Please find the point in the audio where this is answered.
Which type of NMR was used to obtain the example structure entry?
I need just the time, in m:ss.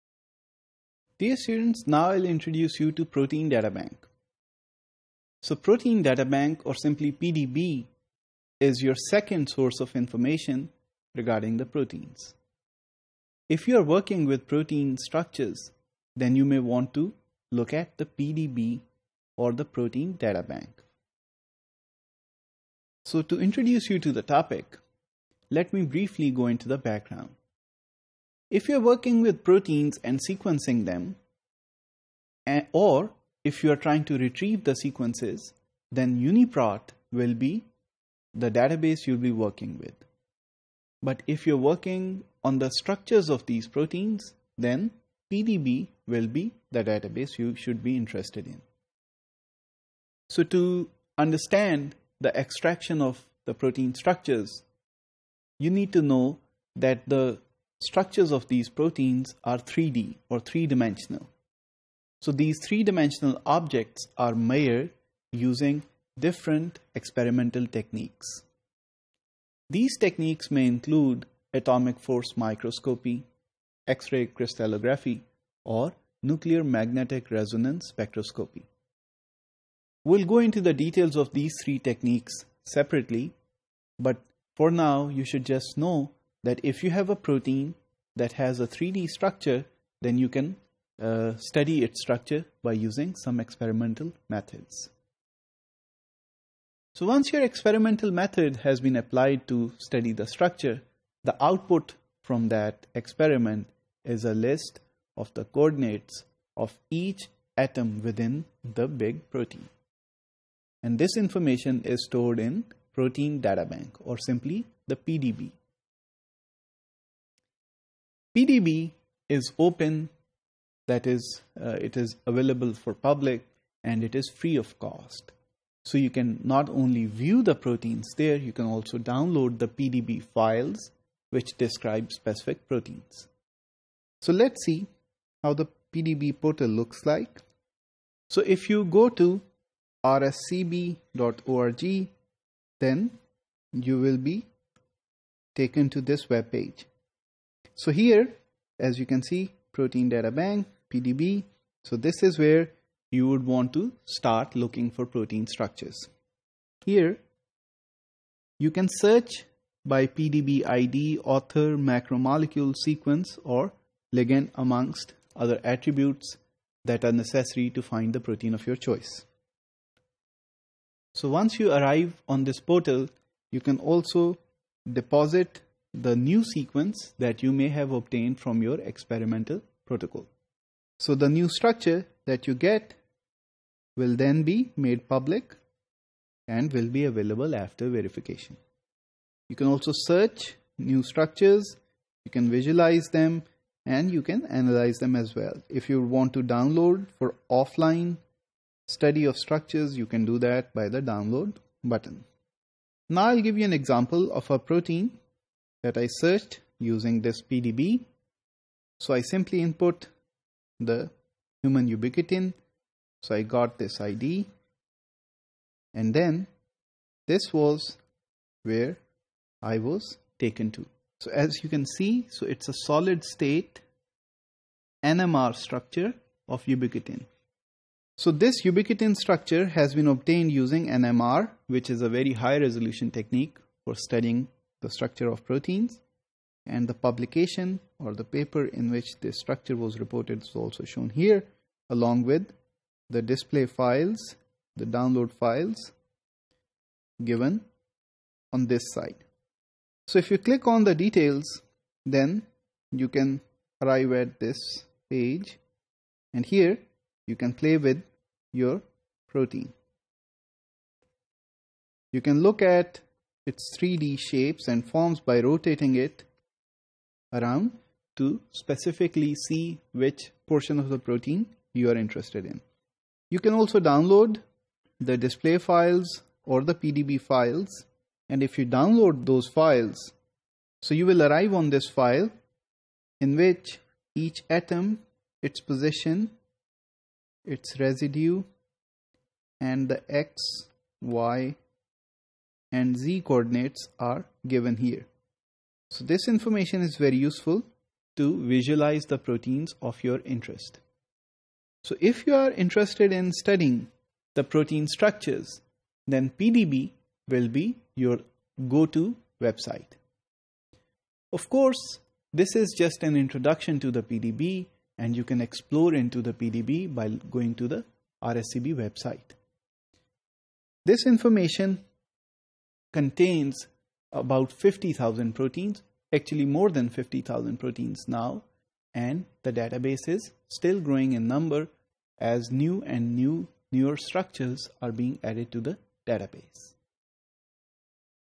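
3:42.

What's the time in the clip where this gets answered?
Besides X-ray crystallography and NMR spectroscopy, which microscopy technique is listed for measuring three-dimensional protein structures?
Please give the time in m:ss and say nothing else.
1:11.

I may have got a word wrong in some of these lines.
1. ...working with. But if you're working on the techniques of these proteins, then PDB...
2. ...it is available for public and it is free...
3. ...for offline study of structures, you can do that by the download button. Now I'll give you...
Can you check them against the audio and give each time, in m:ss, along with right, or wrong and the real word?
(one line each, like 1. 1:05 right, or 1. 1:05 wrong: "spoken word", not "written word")
1. 0:39 wrong: "structures", not "techniques"
2. 2:01 right
3. 3:17 right.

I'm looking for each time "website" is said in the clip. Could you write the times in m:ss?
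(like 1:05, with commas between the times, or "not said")
5:09, 5:18.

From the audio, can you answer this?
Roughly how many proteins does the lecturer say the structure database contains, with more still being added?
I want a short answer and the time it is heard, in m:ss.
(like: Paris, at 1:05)
More than 50,000, at 5:26.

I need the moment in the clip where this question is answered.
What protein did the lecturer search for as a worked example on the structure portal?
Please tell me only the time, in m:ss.
3:31.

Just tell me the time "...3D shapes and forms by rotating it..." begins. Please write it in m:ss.
4:23.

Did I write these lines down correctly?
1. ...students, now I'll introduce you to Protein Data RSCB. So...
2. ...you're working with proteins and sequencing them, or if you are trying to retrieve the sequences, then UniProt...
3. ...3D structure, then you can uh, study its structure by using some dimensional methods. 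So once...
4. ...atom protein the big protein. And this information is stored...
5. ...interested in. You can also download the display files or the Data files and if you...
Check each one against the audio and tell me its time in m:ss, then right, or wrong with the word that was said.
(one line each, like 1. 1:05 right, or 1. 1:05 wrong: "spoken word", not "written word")
1. 0:01 wrong: "Bank", not "RSCB"
2. 0:28 right
3. 1:28 wrong: "experimental", not "dimensional"
4. 1:47 wrong: "within", not "protein"
5. 4:31 wrong: "PDB", not "Data".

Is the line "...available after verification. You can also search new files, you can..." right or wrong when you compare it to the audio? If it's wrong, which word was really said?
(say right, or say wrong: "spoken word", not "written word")
wrong: "structures", not "files".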